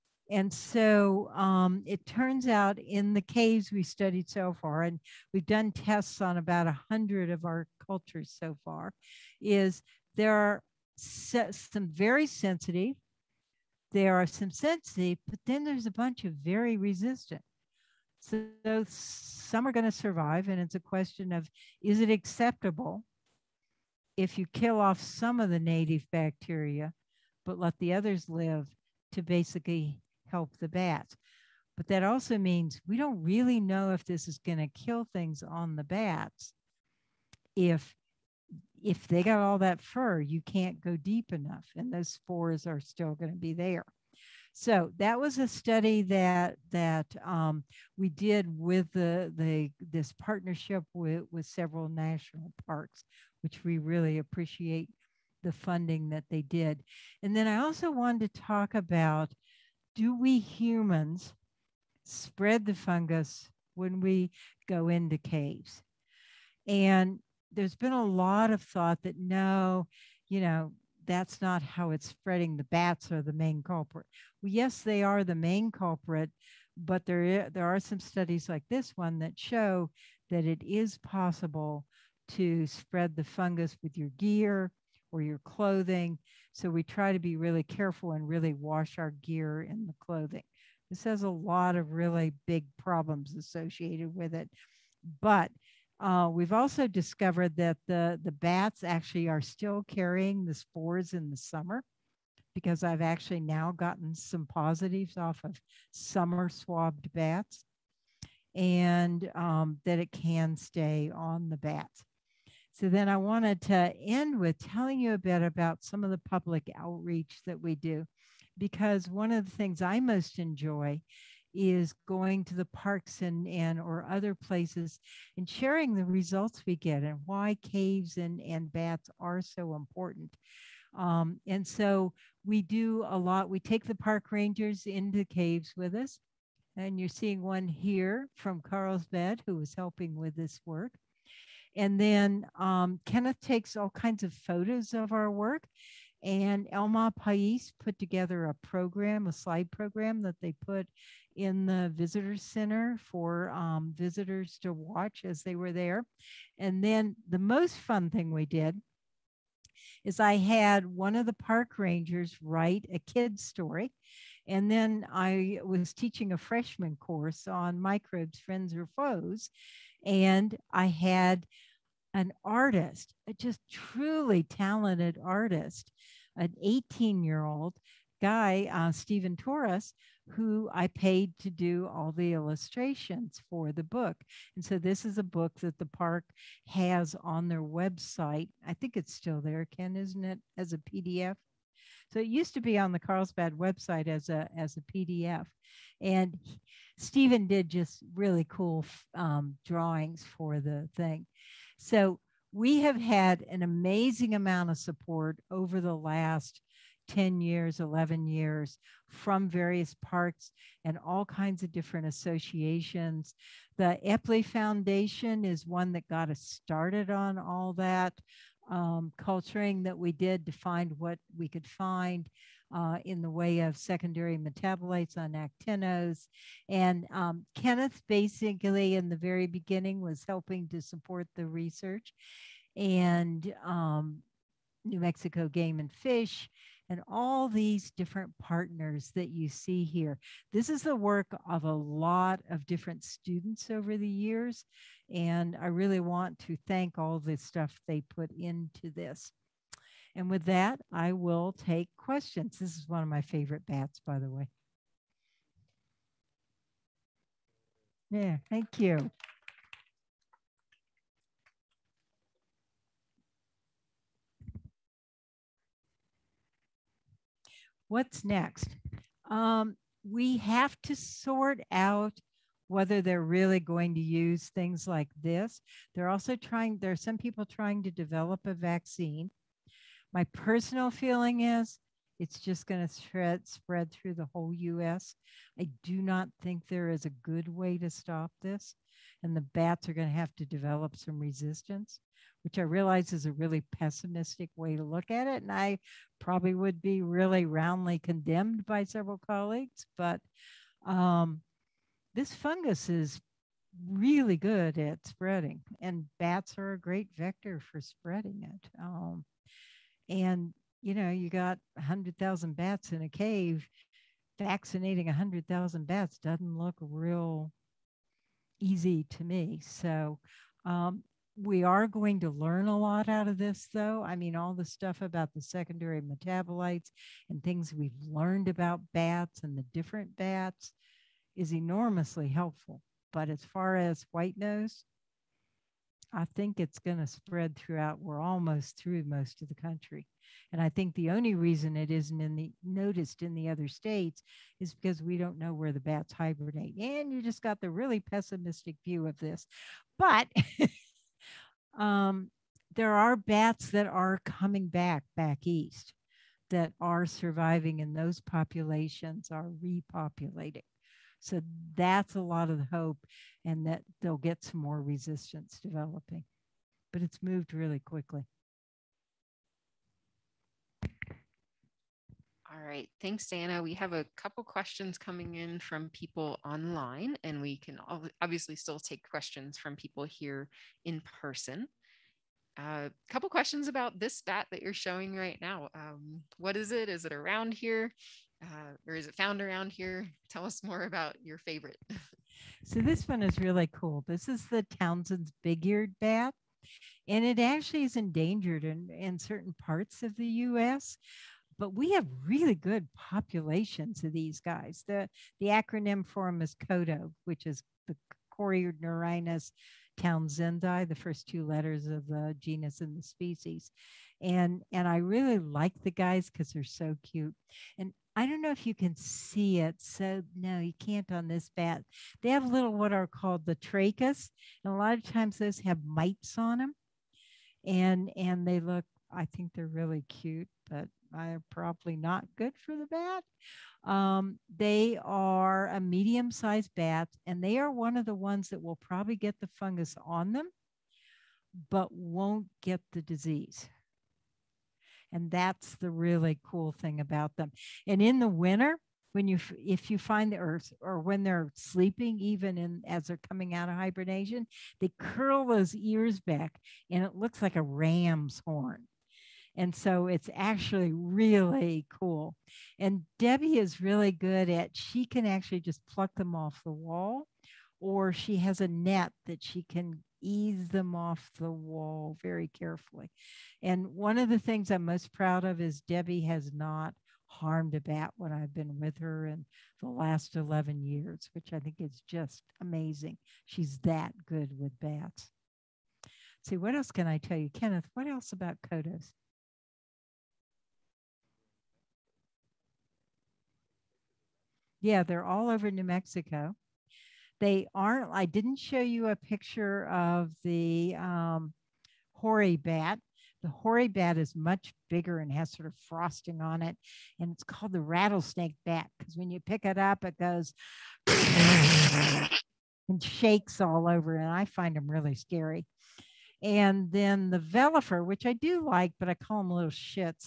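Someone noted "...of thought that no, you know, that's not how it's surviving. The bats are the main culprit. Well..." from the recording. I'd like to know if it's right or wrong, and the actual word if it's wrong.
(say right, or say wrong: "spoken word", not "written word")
wrong: "spreading", not "surviving".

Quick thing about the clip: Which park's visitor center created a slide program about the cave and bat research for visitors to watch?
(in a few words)
El Malpais.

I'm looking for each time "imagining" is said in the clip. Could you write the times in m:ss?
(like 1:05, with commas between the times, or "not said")
not said.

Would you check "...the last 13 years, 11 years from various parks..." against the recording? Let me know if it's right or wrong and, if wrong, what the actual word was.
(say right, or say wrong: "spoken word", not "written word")
wrong: "10", not "13".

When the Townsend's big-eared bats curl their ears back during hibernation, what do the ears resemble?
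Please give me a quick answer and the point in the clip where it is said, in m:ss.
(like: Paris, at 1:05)
A ram's horn, at 7:37.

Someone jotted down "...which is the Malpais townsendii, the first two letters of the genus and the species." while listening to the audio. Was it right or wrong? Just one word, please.
wrong.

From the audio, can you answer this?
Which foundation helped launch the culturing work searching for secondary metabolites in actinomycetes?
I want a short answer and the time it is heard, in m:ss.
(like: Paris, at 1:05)
Eppley Foundation, at 3:33.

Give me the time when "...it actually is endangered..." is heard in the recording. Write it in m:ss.
6:37.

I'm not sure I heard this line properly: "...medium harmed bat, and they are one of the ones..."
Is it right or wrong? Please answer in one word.
wrong.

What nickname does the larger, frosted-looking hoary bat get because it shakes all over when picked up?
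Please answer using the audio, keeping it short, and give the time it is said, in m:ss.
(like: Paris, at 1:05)
Rattlesnake bat, at 8:27.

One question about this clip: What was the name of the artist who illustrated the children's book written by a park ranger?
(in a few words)
Stephen Torres.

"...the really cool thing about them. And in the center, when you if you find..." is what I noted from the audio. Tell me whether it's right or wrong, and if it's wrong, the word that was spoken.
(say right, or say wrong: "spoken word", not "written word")
wrong: "winter", not "center".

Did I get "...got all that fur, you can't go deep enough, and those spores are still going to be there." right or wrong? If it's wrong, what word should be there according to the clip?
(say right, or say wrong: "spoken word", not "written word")
right.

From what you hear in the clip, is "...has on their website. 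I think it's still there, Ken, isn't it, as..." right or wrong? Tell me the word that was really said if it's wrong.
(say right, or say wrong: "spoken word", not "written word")
right.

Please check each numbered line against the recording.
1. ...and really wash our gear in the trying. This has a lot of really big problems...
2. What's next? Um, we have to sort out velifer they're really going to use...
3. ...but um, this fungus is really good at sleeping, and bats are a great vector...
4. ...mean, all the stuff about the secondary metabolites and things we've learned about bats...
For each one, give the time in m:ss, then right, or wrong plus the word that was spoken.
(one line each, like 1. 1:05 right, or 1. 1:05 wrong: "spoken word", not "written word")
1. 1:28 wrong: "clothing", not "trying"
2. 4:27 wrong: "whether", not "velifer"
3. 4:59 wrong: "spreading", not "sleeping"
4. 5:24 right.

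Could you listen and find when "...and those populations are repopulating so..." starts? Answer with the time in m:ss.
5:57.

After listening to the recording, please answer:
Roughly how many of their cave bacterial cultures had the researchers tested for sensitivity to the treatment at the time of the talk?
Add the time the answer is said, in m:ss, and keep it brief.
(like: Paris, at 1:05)
100, at 0:06.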